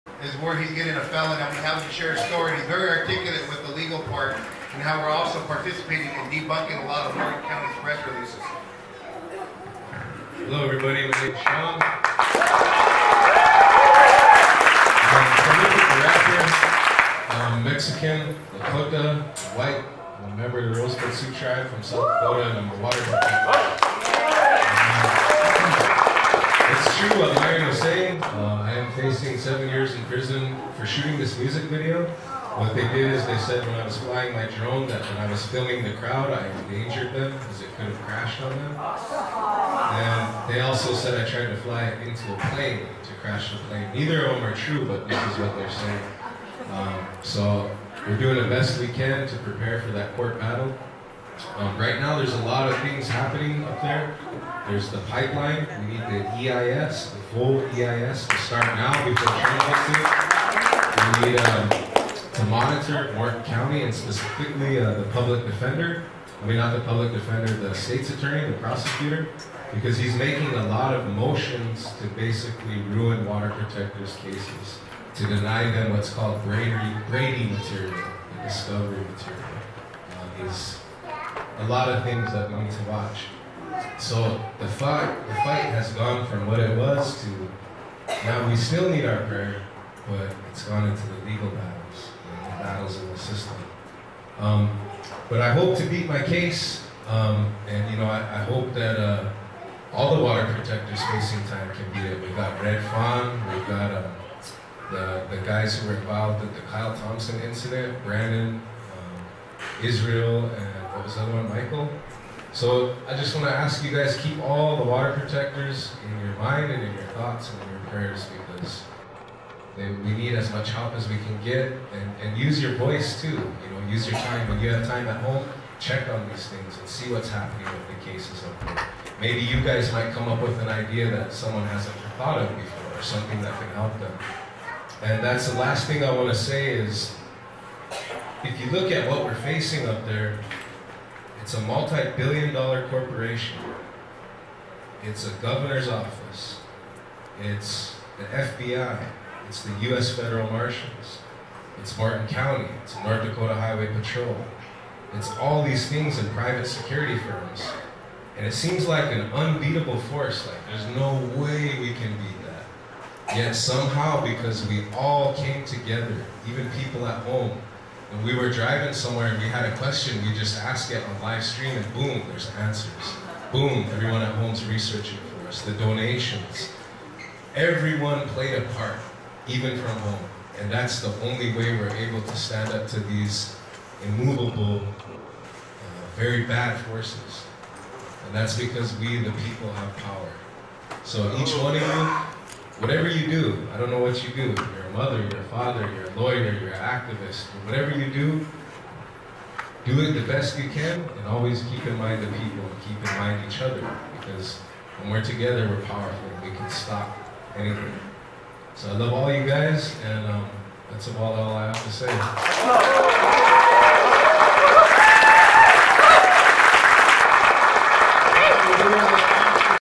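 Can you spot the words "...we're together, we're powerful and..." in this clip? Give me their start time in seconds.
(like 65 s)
205 s.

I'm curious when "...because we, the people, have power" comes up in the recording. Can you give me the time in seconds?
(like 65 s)
188 s.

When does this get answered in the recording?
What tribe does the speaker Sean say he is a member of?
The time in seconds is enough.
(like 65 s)
20 s.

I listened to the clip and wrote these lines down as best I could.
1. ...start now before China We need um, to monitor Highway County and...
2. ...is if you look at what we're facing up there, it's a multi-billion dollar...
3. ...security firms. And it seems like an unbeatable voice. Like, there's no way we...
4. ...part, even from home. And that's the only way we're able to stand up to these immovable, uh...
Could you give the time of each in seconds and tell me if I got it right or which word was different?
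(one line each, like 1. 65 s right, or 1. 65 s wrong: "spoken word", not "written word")
1. 58 s wrong: "Morton", not "Highway"
2. 136 s right
3. 156 s wrong: "force", not "voice"
4. 178 s right.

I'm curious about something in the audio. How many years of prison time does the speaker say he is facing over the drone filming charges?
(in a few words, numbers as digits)
7.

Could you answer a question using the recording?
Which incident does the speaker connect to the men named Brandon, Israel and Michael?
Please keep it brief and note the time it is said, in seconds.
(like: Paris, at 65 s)
Kyle Thompson incident, at 106 s.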